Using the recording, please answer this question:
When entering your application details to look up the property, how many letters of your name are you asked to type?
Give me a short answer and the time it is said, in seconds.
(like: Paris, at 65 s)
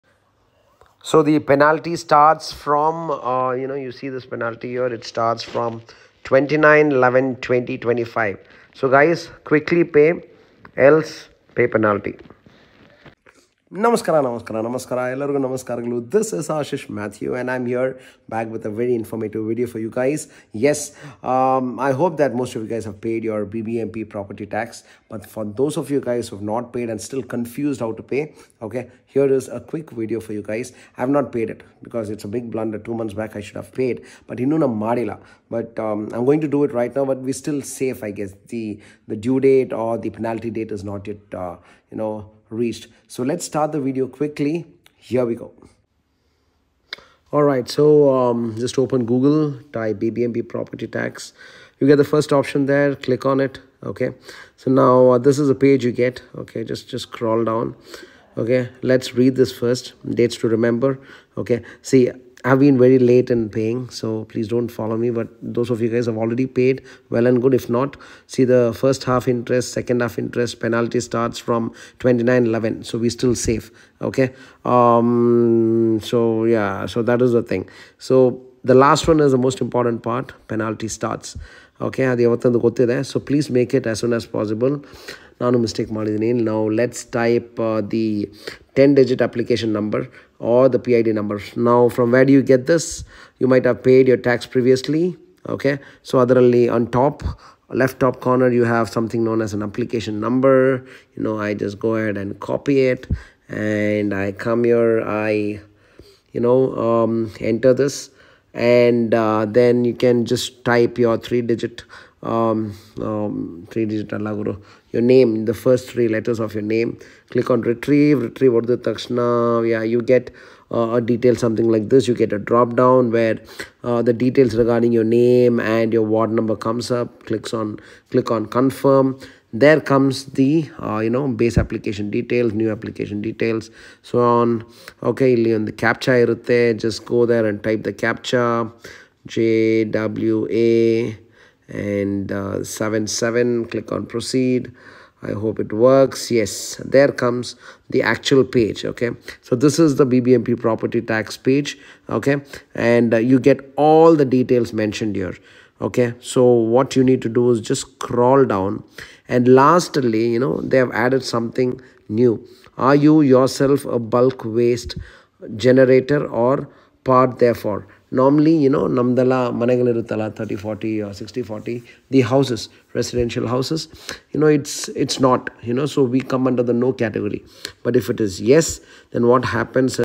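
3, at 115 s.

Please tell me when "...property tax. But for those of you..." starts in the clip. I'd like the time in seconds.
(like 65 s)
24 s.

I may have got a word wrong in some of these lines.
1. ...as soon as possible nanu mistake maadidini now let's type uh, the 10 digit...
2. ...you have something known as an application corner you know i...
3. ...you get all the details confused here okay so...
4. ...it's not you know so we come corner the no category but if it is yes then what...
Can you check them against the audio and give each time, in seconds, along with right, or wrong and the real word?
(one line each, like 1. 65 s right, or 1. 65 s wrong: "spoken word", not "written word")
1. 83 s right
2. 98 s wrong: "number", not "corner"
3. 153 s wrong: "mentioned", not "confused"
4. 175 s wrong: "under", not "corner".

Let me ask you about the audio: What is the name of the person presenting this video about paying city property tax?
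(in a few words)
Ashish Mathew.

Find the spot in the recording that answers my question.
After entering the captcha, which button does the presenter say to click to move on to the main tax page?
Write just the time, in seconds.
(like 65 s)
144 s.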